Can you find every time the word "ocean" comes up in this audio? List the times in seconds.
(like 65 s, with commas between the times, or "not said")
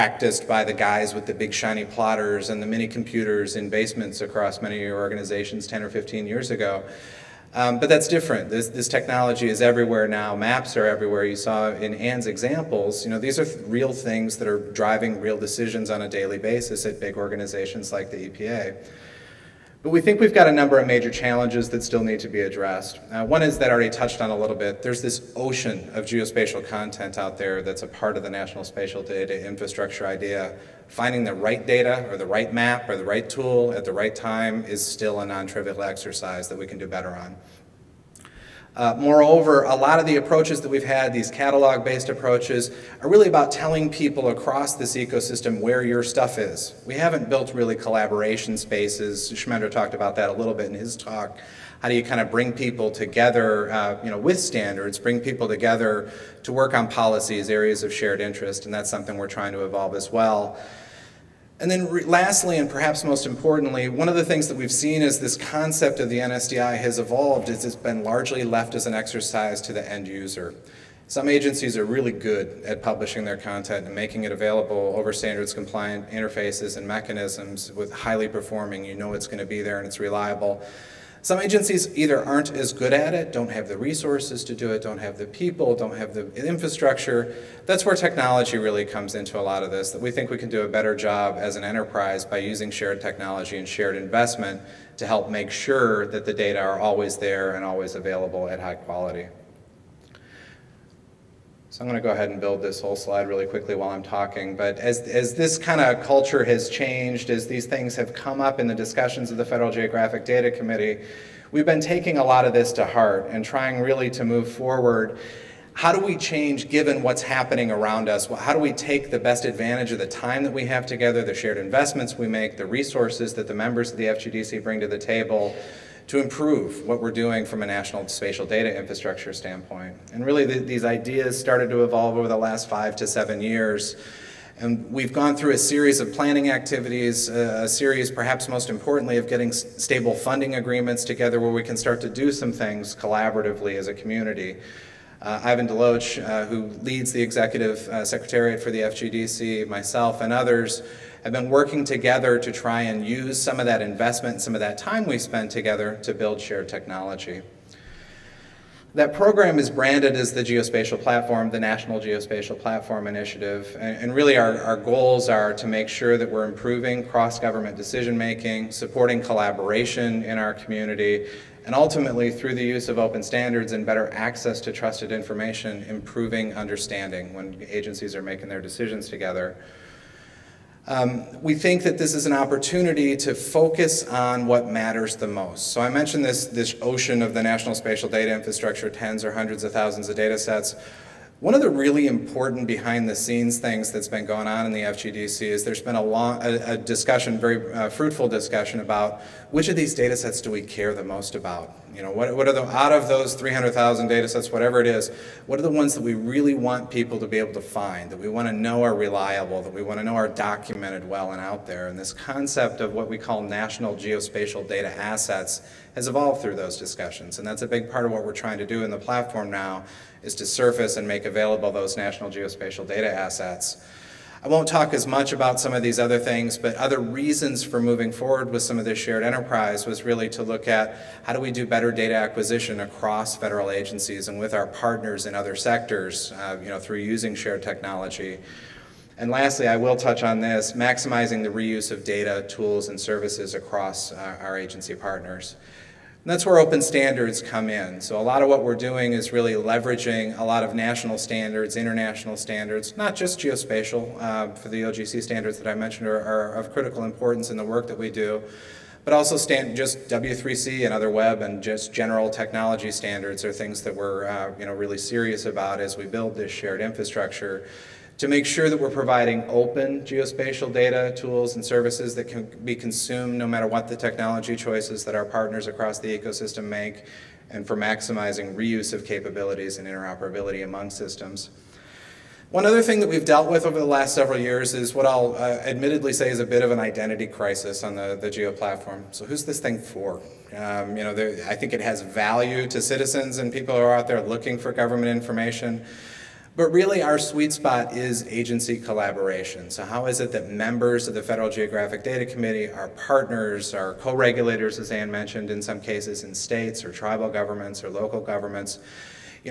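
25 s, 186 s.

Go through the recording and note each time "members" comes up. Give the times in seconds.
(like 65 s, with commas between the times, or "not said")
123 s, 300 s.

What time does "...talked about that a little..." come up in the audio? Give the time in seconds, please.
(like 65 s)
49 s.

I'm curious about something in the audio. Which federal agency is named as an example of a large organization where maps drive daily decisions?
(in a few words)
EPA.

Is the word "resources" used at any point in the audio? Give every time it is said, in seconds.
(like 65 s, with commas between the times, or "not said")
83 s, 122 s.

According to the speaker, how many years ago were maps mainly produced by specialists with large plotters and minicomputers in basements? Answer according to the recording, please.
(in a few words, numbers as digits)
10 or 15 years.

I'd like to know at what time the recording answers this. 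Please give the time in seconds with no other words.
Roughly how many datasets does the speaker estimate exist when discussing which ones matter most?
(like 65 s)
203 s.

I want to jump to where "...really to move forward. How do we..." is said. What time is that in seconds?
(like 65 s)
113 s.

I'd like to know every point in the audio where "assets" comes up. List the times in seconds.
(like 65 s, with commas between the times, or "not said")
214 s, 223 s.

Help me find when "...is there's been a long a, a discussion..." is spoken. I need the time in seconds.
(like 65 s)
195 s.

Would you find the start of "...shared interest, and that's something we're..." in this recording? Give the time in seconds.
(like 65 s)
57 s.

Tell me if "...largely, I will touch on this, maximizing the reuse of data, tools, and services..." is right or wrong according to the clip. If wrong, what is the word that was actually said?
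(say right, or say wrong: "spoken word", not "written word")
wrong: "lastly", not "largely".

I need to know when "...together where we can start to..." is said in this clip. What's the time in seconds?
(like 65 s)
141 s.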